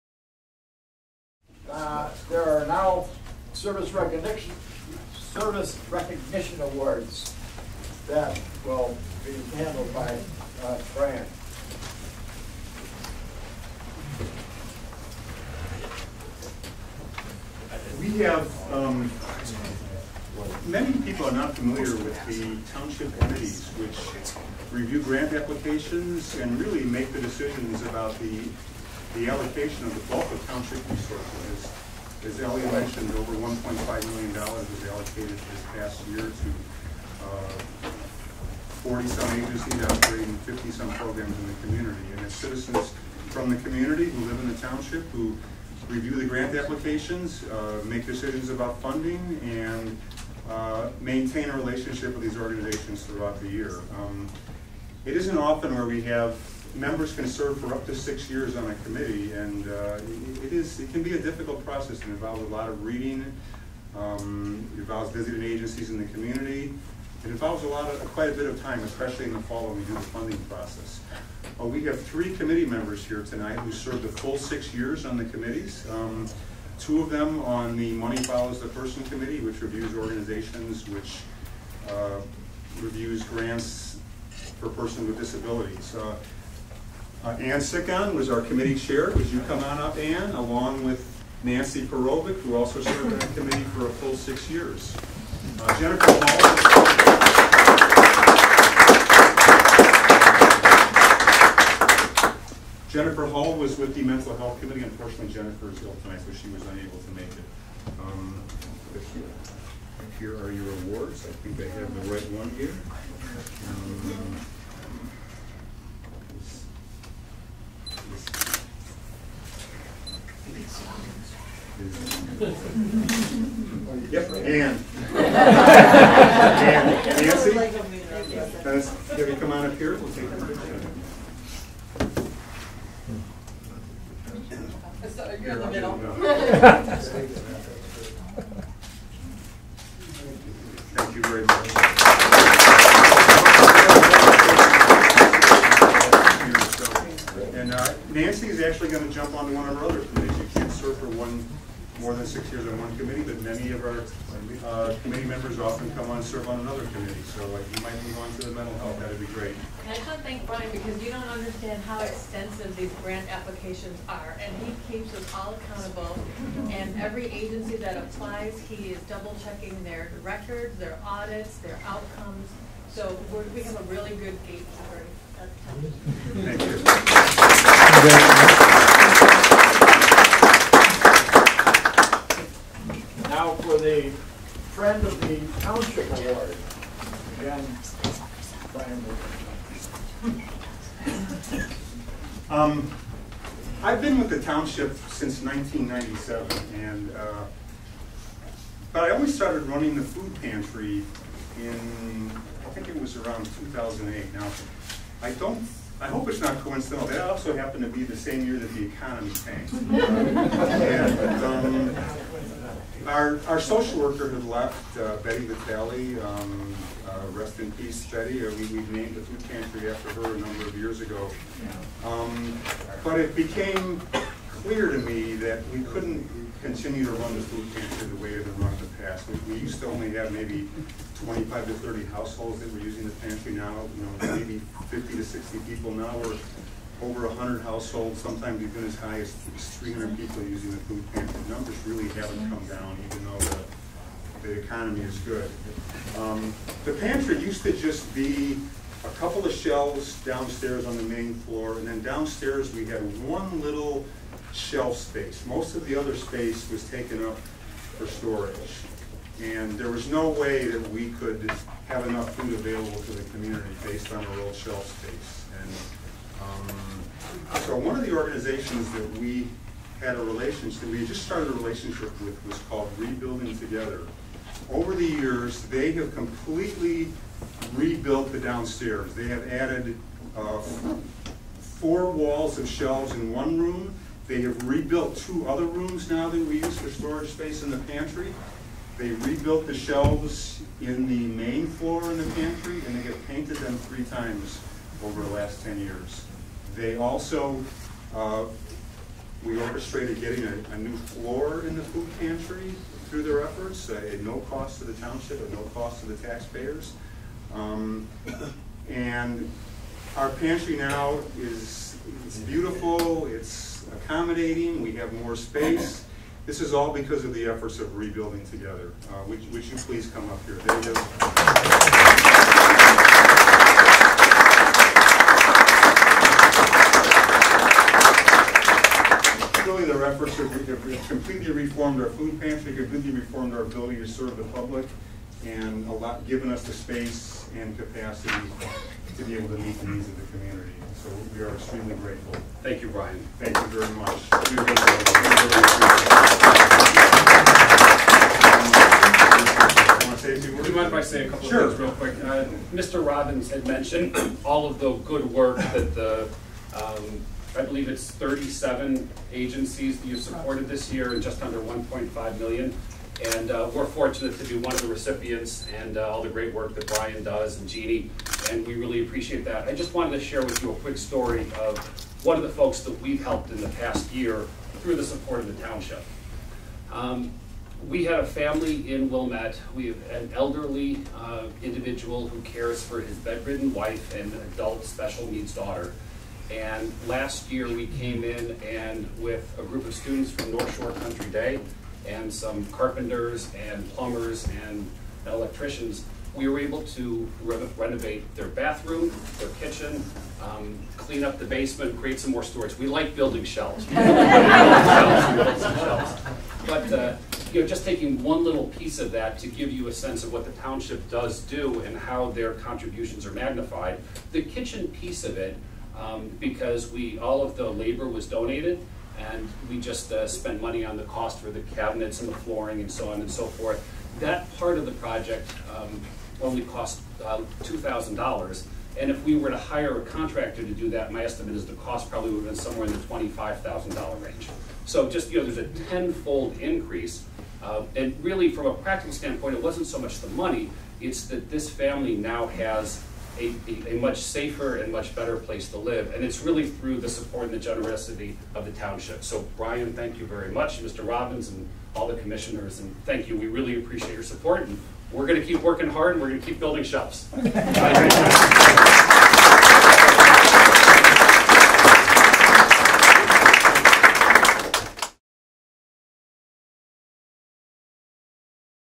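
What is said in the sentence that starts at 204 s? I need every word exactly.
Now, I don't I hope it's not coincidental.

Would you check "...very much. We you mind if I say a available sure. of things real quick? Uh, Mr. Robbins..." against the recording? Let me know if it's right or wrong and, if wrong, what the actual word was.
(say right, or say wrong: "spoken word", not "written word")
wrong: "couple", not "available".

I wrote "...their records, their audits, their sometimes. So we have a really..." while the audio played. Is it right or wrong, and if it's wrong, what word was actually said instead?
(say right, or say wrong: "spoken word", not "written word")
wrong: "outcomes", not "sometimes".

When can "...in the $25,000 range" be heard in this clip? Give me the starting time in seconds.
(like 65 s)
432 s.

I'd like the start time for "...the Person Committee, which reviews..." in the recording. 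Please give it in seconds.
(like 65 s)
78 s.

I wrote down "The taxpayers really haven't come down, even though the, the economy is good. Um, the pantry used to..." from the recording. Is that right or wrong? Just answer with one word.
wrong.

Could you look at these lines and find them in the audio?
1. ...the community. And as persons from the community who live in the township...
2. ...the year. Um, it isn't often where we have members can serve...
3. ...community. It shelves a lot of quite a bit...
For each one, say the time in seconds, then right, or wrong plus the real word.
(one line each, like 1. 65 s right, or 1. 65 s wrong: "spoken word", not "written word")
1. 41 s wrong: "citizens", not "persons"
2. 53 s right
3. 66 s wrong: "involves", not "shelves".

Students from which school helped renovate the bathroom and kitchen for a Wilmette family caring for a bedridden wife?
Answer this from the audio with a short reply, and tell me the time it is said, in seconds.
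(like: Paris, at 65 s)
North Shore Country Day, at 390 s.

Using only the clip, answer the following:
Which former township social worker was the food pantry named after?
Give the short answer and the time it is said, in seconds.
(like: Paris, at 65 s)
Betty Vitale, at 215 s.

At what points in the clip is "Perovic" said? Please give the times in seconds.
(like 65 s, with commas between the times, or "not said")
91 s.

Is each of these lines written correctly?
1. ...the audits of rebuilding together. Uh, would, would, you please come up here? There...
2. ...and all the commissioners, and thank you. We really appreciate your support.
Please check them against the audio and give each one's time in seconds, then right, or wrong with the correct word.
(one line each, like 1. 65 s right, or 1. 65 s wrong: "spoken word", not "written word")
1. 317 s wrong: "efforts", not "audits"
2. 451 s right.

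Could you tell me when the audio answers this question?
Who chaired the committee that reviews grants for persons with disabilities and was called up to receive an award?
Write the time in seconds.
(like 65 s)
87 s.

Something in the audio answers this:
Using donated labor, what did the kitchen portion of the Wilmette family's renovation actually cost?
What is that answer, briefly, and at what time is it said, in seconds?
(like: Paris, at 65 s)
$2,000, at 427 s.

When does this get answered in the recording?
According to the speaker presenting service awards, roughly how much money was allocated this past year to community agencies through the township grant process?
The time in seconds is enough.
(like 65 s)
33 s.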